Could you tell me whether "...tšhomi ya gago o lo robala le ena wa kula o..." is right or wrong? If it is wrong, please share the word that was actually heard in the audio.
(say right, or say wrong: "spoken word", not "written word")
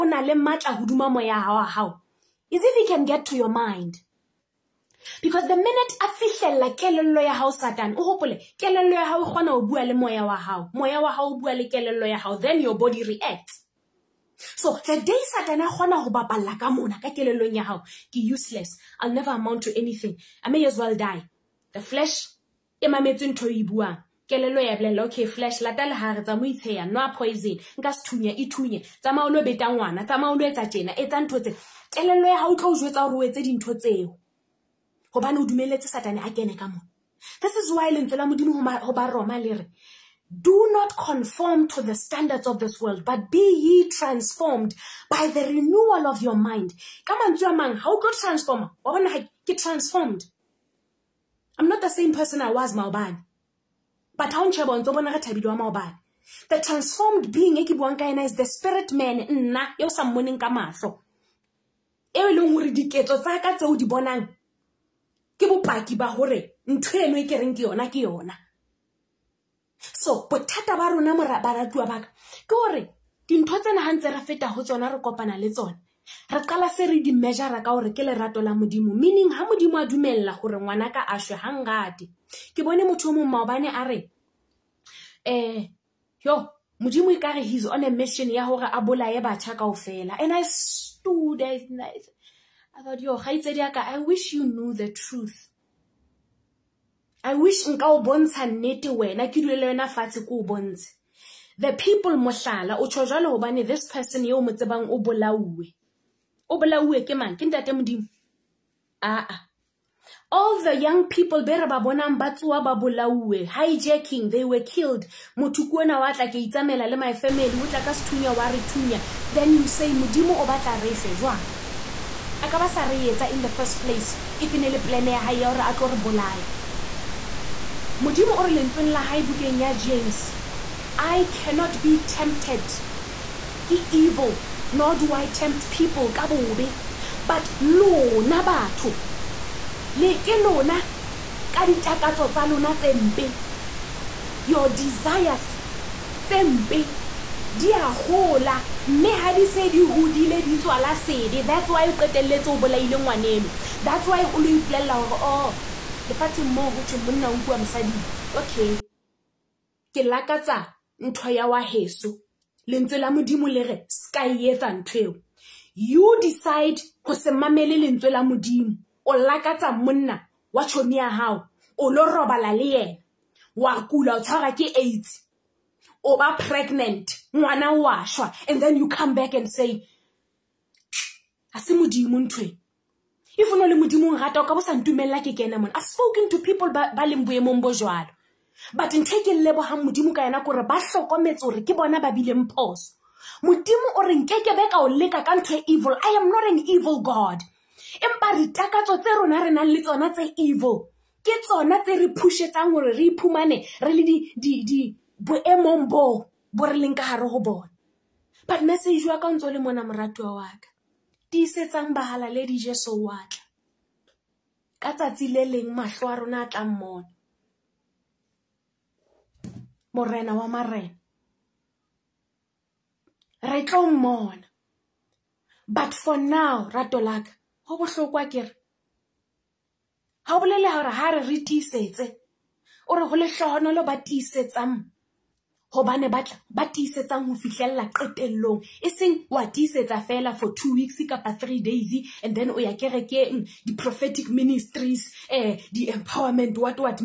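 right.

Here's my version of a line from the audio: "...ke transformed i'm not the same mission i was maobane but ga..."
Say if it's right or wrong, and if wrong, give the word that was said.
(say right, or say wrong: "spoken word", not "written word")
wrong: "person", not "mission".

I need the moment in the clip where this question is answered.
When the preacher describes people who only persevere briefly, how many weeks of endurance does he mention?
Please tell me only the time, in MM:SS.
04:00.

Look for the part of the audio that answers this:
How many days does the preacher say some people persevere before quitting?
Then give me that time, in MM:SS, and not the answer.
04:01.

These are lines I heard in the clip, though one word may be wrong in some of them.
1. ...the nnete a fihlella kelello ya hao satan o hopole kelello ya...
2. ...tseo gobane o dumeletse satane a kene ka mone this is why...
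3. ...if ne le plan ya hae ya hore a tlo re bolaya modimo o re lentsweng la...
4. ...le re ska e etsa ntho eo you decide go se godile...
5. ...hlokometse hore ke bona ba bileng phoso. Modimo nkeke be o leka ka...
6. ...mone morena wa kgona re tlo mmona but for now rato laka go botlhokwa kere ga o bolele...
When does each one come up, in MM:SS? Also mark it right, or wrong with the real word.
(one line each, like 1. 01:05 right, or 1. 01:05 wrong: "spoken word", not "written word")
1. 00:05 wrong: "minute", not "nnete"
2. 00:33 right
3. 02:04 right
4. 02:43 wrong: "mamele", not "godile"
5. 03:10 right
6. 03:36 wrong: "marena", not "kgona".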